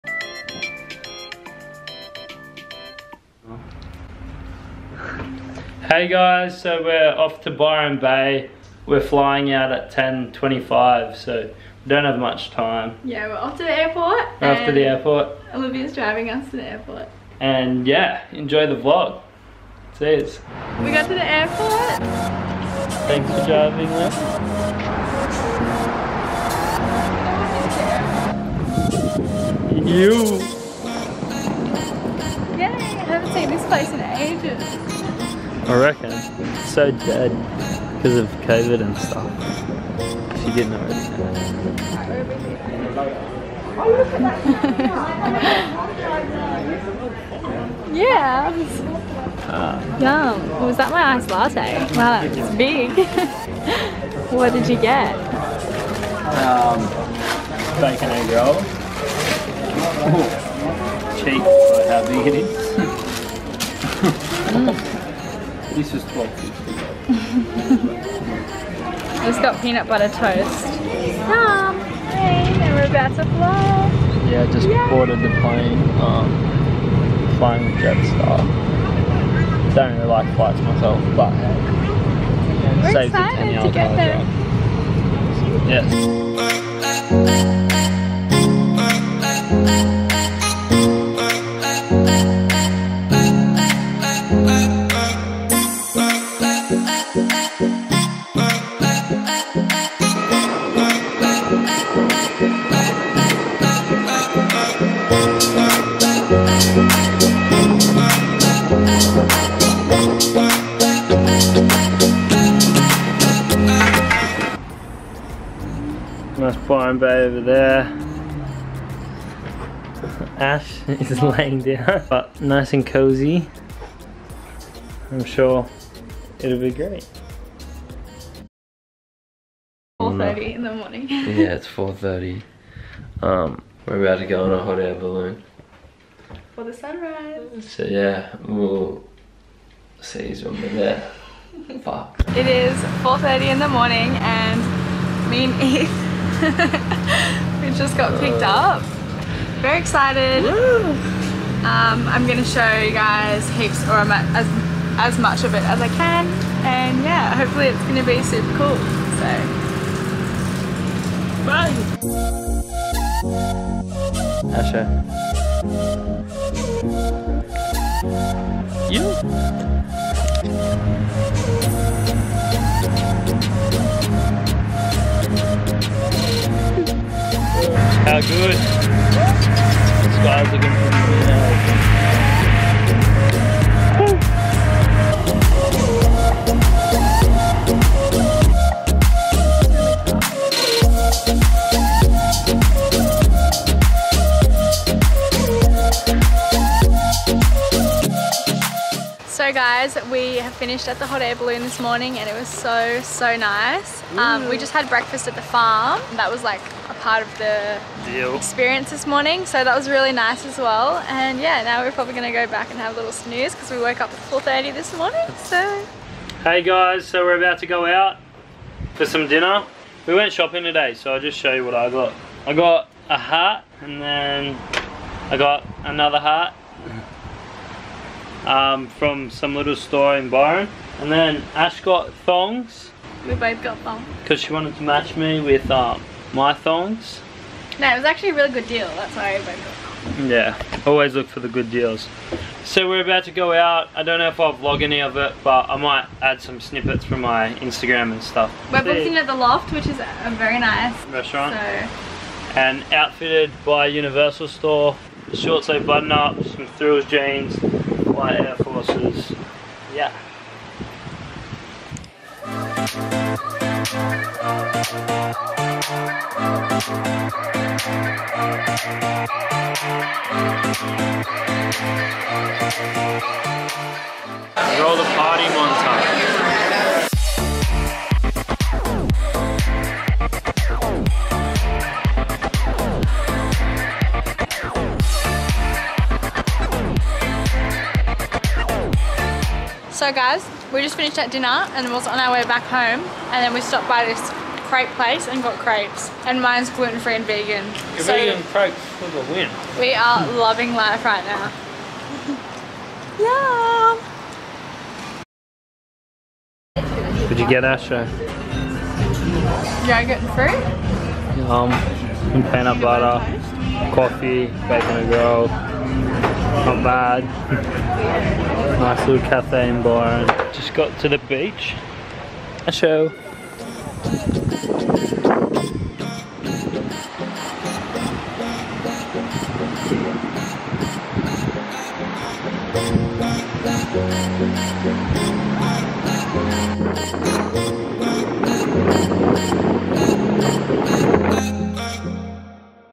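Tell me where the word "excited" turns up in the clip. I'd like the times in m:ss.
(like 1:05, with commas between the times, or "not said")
1:23, 2:29.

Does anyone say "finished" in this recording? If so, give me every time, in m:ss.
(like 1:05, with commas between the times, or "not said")
3:20, 4:50.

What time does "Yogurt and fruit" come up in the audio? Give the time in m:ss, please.
5:09.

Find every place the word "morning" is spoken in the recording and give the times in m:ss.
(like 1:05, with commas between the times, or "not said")
2:10, 2:23, 3:21, 3:29, 3:34.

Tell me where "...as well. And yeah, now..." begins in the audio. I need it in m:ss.
3:30.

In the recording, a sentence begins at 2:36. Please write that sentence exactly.
And yeah, hopefully it's gonna be super cool.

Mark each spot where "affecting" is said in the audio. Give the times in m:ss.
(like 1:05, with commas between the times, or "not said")
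not said.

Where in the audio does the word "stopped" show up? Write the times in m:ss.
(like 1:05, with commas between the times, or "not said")
4:53.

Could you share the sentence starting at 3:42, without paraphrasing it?
I got a hat and then I got another hat um, from some little store in Byron.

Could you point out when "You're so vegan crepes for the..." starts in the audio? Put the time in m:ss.
4:57.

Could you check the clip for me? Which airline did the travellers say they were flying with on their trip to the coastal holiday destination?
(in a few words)
Jetstar.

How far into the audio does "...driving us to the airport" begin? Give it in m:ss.
0:15.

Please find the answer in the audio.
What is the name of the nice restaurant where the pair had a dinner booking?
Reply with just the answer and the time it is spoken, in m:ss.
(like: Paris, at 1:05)
The Loft, at 4:09.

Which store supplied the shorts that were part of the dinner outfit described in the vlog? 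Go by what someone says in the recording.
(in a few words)
Universal Store.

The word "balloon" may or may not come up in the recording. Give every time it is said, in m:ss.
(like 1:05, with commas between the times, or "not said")
2:14, 3:21.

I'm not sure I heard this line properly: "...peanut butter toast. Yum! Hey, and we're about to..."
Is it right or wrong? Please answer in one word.
right.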